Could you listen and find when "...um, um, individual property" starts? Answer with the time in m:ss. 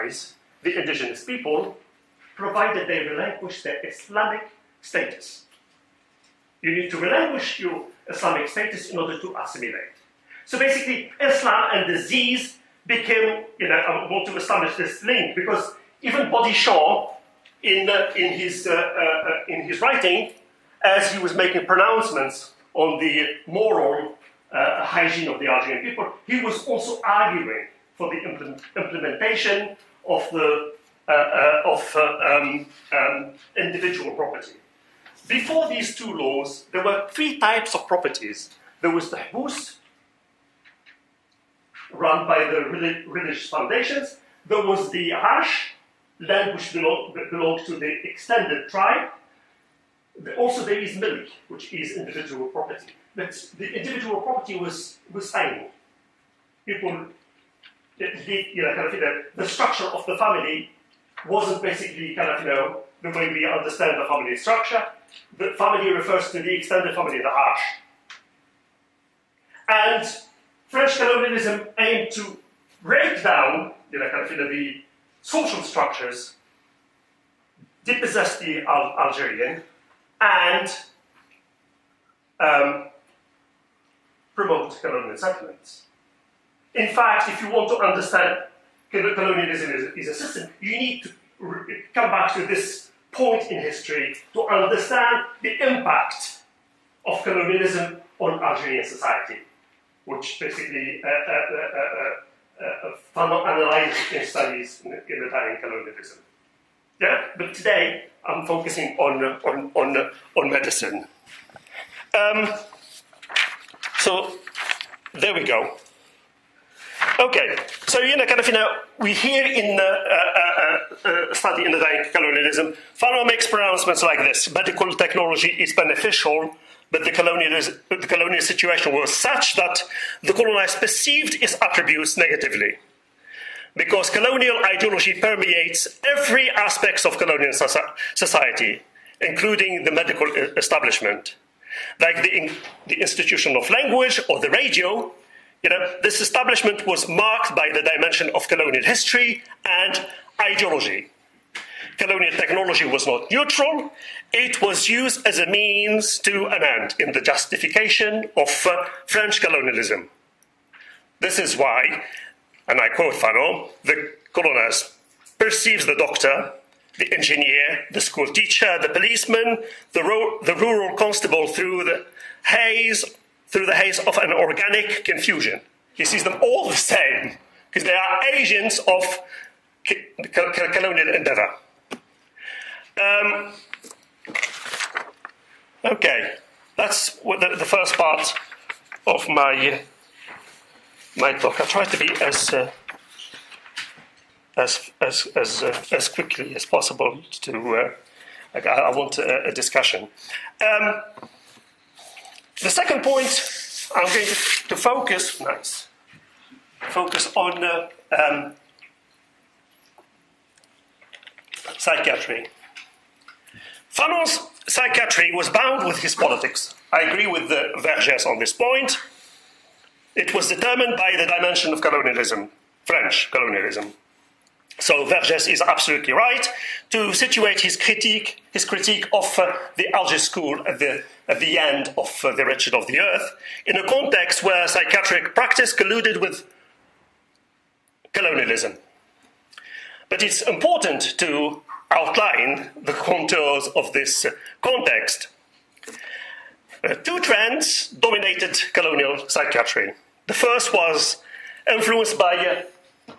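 0:31.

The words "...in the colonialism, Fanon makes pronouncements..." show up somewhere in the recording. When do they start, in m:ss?
2:01.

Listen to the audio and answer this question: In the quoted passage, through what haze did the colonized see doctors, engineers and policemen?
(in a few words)
An organic confusion.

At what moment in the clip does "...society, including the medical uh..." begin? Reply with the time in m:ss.
2:18.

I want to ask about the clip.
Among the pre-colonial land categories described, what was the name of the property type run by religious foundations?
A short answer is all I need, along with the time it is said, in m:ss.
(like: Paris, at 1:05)
Habus, at 0:39.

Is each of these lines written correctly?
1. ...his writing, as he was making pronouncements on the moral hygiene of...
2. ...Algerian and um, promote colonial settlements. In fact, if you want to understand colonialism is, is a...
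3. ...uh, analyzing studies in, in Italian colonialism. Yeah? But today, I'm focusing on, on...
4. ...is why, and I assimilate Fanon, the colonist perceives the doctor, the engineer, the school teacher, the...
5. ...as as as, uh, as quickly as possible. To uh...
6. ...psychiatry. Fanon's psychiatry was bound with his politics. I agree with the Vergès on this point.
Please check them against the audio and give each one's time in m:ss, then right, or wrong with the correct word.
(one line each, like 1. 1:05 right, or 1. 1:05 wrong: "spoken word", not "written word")
1. 0:19 right
2. 1:19 right
3. 1:42 right
4. 2:41 wrong: "quote", not "assimilate"
5. 3:14 right
6. 3:31 right.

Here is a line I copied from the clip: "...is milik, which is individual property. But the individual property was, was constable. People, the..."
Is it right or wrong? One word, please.
wrong.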